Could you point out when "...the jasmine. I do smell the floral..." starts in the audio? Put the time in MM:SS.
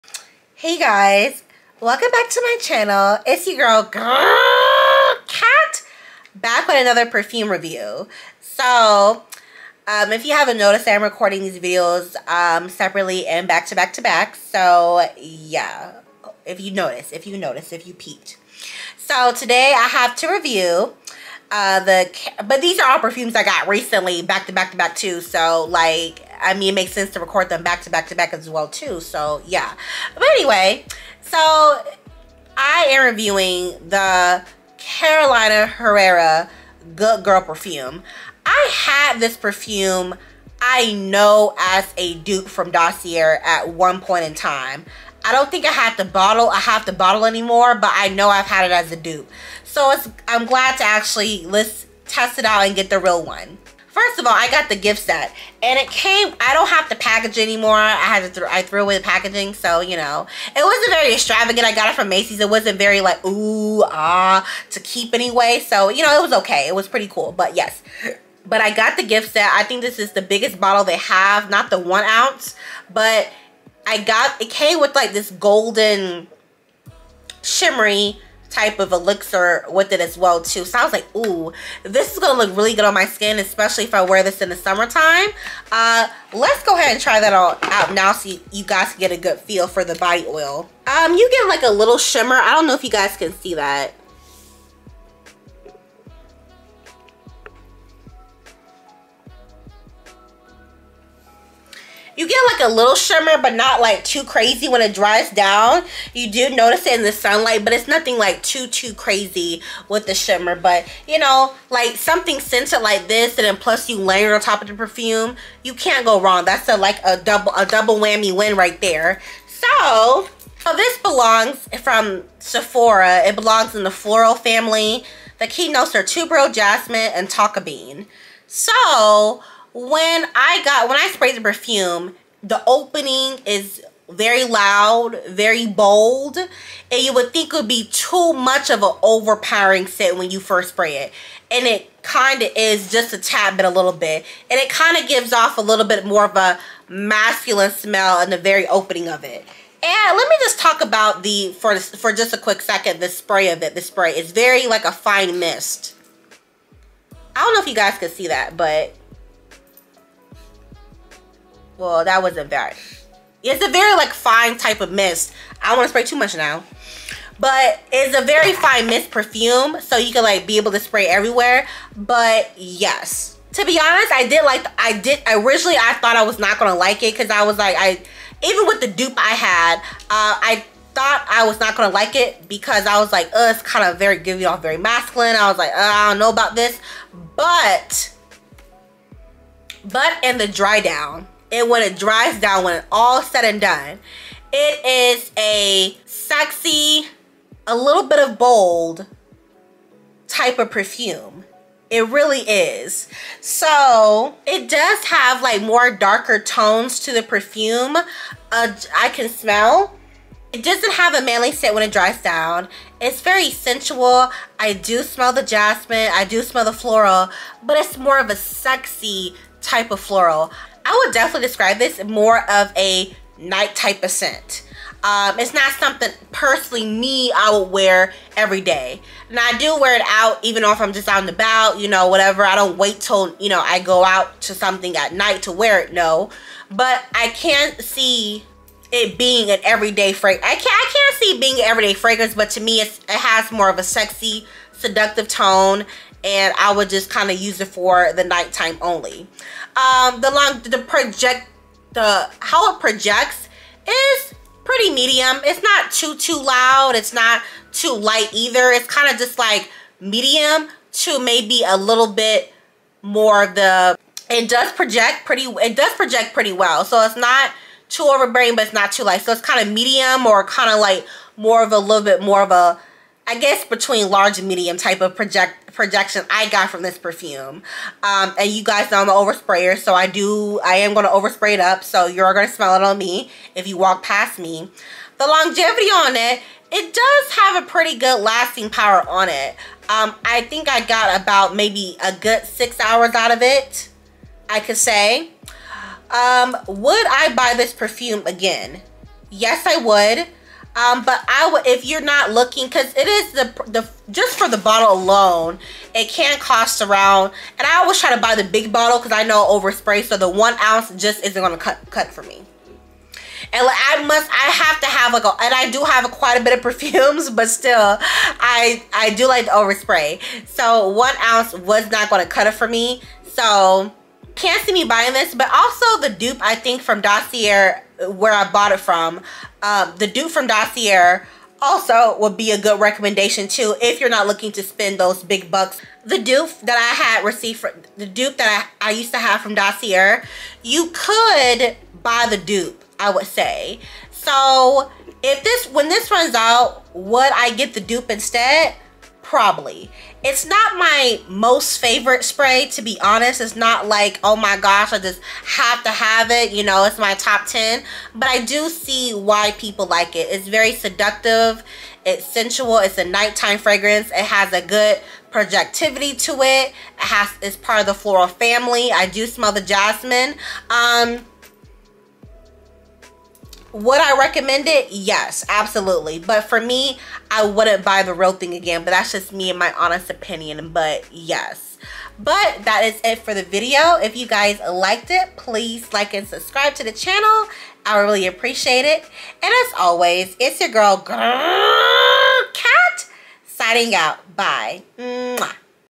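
03:35.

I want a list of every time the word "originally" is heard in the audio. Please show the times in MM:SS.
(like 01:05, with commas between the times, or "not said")
02:55.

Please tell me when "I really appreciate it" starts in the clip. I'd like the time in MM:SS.
06:27.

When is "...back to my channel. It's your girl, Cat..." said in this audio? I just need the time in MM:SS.
00:02.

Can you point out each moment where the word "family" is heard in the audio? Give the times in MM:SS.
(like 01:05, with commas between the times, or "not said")
02:04, 06:08.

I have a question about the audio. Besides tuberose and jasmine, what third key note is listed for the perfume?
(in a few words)
tonka bean.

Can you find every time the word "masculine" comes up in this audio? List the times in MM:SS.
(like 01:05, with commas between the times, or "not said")
02:26, 03:04.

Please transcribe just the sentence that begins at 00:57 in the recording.
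I had to, th I threw away the packaging.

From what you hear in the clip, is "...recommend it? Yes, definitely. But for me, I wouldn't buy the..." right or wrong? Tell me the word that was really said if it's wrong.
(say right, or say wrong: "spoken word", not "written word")
wrong: "absolutely", not "definitely".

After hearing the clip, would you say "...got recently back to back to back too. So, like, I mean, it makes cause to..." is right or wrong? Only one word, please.
wrong.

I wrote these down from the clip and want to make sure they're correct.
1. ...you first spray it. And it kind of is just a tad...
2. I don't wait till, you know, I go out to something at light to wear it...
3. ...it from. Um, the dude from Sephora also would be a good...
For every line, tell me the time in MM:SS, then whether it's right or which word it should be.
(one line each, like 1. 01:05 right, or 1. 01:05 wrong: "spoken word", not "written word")
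1. 02:20 right
2. 03:52 wrong: "night", not "light"
3. 05:28 wrong: "Dossier", not "Sephora".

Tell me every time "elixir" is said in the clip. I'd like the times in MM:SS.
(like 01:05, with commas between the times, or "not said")
01:18.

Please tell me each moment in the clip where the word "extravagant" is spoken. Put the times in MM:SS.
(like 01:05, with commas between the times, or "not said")
01:01.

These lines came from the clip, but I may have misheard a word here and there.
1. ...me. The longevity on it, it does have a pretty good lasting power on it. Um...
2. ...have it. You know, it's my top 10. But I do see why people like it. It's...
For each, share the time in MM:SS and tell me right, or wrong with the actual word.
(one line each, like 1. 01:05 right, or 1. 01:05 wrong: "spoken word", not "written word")
1. 04:44 right
2. 05:55 right.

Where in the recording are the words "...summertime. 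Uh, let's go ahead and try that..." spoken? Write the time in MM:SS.
01:24.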